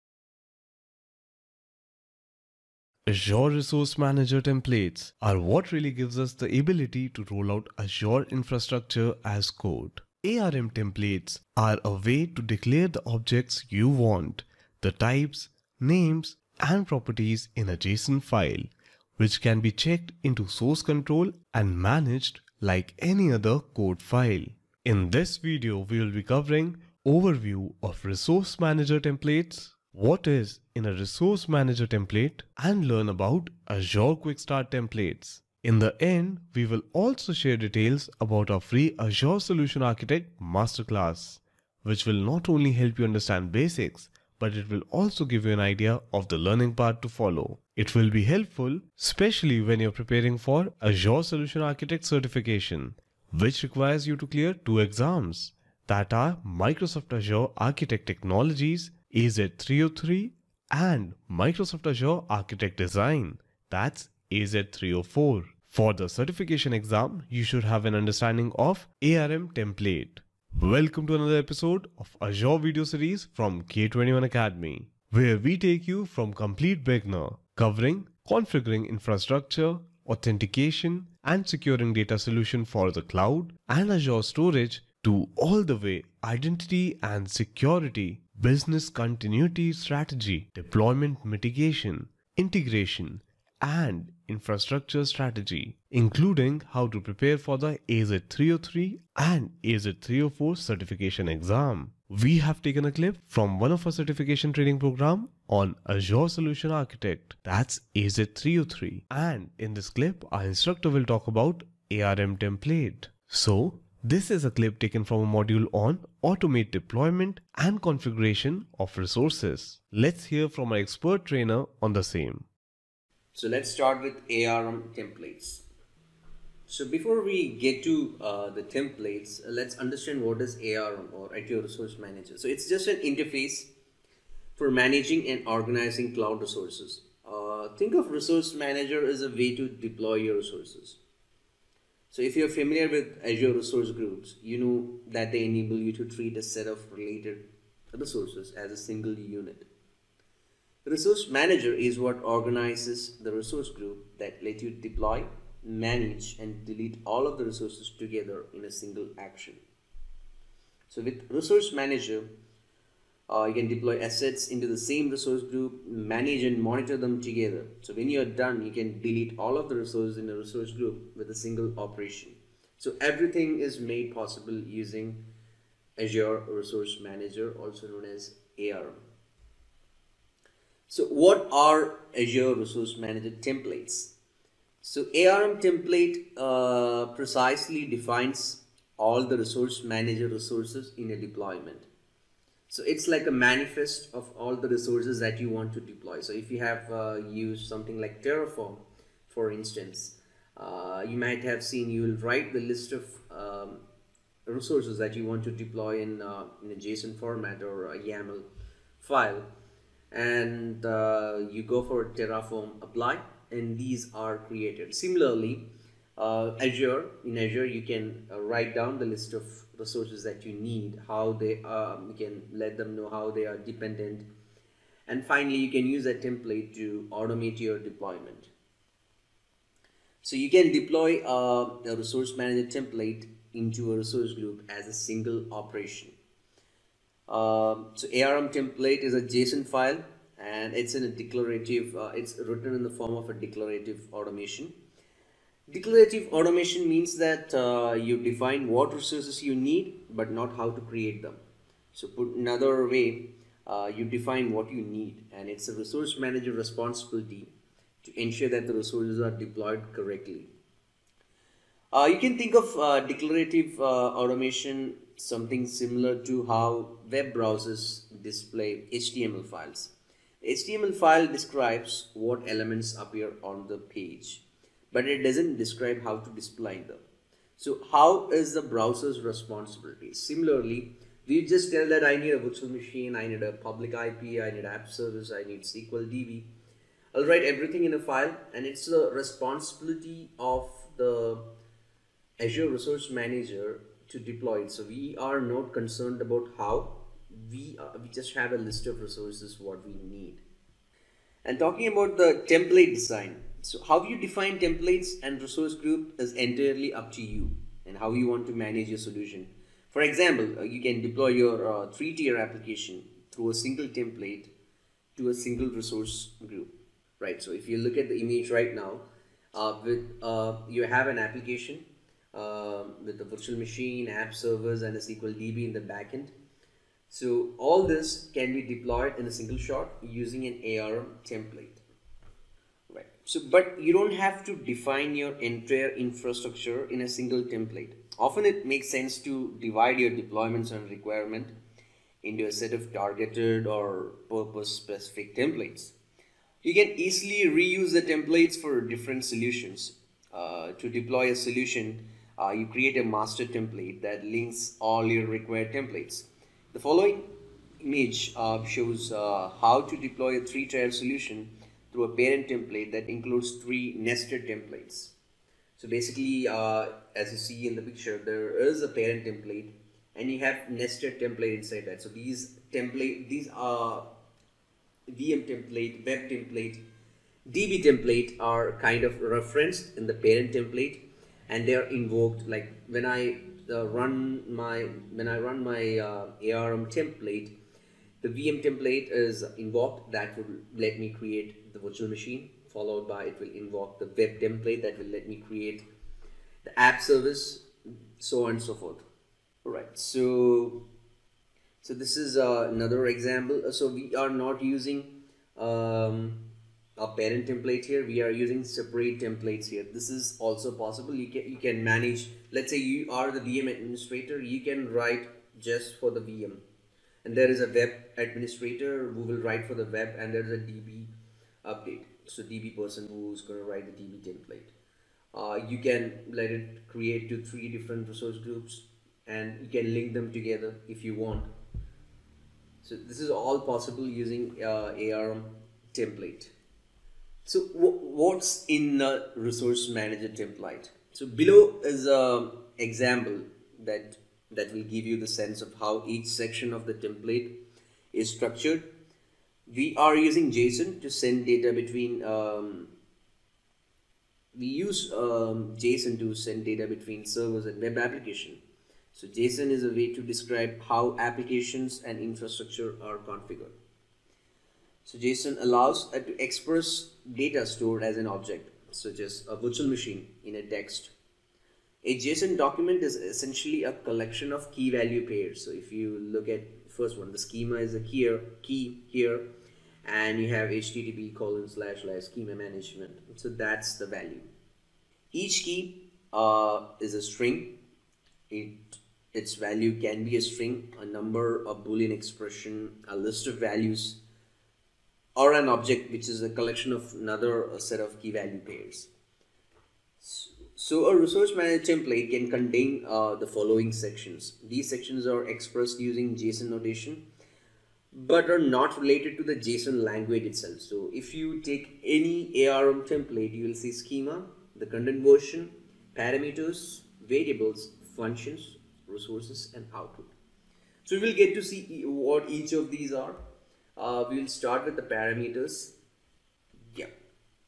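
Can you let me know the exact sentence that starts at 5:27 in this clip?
So all this can be deployed in a single shot using an ARM template.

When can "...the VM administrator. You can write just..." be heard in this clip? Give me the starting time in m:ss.
6:53.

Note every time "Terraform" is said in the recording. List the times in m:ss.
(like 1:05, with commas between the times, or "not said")
3:18, 3:32.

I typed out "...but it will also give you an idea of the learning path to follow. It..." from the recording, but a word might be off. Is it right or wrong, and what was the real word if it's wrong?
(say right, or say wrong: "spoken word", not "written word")
right.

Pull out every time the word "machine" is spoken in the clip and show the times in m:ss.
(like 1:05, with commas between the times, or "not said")
4:42, 5:23, 6:32, 7:49.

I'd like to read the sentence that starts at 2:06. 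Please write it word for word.
So before we get to uh, the templates, uh, let's understand what is ARM or IT Resource Manager.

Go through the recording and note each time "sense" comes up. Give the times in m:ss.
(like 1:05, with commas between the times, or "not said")
5:38, 7:25.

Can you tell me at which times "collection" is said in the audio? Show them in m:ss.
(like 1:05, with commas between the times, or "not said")
7:53, 8:16.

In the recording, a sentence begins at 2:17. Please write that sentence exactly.
Uh, think of resource manager as a way to deploy your resources.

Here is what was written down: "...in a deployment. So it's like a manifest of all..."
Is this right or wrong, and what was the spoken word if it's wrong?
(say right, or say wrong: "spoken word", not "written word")
right.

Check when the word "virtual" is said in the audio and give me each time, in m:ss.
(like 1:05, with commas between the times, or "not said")
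4:42, 5:23, 6:31, 7:49.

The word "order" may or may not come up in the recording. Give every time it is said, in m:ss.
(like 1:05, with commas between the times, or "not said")
not said.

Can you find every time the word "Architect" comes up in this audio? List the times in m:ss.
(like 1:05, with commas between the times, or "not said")
0:39, 0:51, 0:57, 1:02, 1:46.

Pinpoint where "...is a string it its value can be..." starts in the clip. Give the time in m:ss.
8:06.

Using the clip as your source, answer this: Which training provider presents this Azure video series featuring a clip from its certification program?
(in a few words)
K21 Academy.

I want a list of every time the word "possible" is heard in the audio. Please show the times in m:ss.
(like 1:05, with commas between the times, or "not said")
2:54, 6:50, 7:13.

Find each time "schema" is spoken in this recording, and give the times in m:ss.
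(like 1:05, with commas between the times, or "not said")
7:57, 8:02, 8:33.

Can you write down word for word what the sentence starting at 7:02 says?
So DB person who's going to write the DB template.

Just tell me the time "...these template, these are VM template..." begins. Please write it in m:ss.
6:12.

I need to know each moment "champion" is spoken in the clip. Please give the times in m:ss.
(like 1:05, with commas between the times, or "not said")
not said.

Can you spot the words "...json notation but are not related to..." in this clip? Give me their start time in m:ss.
8:26.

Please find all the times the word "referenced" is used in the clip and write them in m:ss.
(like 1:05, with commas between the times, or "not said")
6:19.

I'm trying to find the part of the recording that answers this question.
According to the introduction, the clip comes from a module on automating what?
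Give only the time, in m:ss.
1:56.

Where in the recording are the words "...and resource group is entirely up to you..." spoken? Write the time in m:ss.
5:05.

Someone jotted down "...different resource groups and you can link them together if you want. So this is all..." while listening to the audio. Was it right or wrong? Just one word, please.
right.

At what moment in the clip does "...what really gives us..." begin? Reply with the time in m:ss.
0:05.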